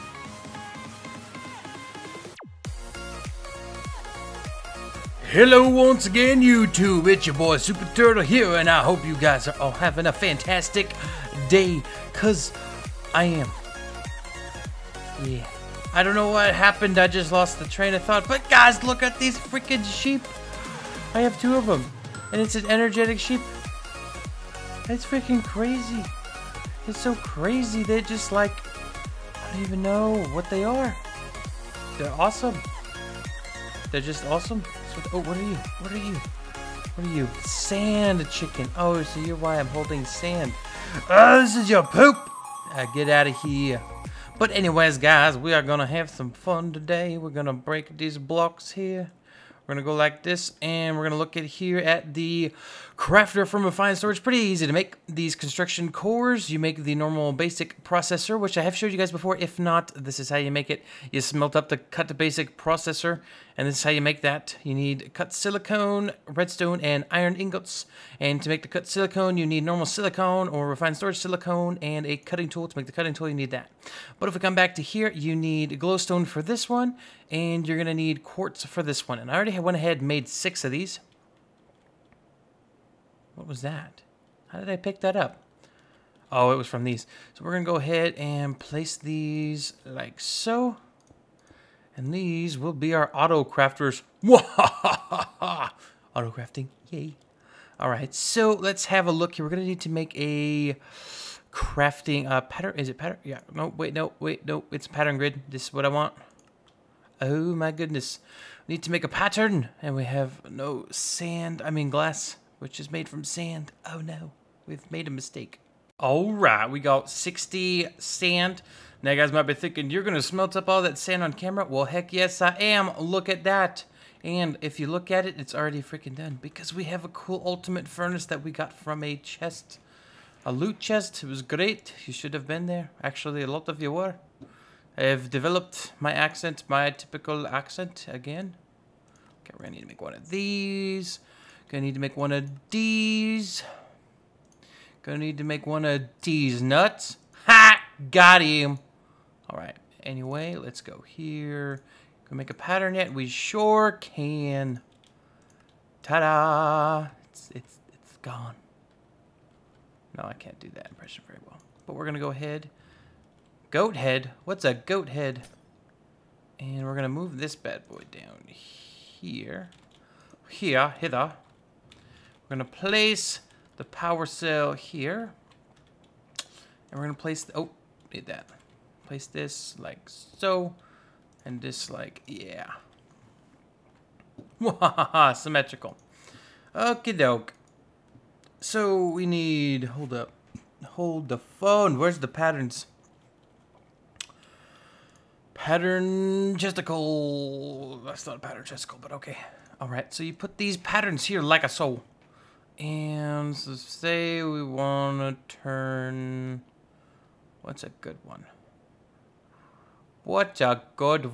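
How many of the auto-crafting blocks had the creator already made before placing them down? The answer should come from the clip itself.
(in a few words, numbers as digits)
6.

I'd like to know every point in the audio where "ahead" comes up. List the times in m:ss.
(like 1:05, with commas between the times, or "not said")
1:19, 1:27, 2:42.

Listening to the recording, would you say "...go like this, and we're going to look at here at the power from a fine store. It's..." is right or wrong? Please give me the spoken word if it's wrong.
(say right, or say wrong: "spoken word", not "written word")
wrong: "crafter", not "power".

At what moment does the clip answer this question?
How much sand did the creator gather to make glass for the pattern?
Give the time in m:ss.
1:57.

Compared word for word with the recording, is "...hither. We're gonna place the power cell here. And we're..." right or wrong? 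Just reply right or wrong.
right.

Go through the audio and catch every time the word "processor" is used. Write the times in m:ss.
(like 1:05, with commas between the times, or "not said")
0:57, 1:02.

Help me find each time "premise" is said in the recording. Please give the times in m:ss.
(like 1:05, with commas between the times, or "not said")
not said.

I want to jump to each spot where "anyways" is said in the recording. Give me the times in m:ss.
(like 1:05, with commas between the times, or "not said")
0:44, 2:30.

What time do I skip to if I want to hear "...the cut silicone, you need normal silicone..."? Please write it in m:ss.
1:08.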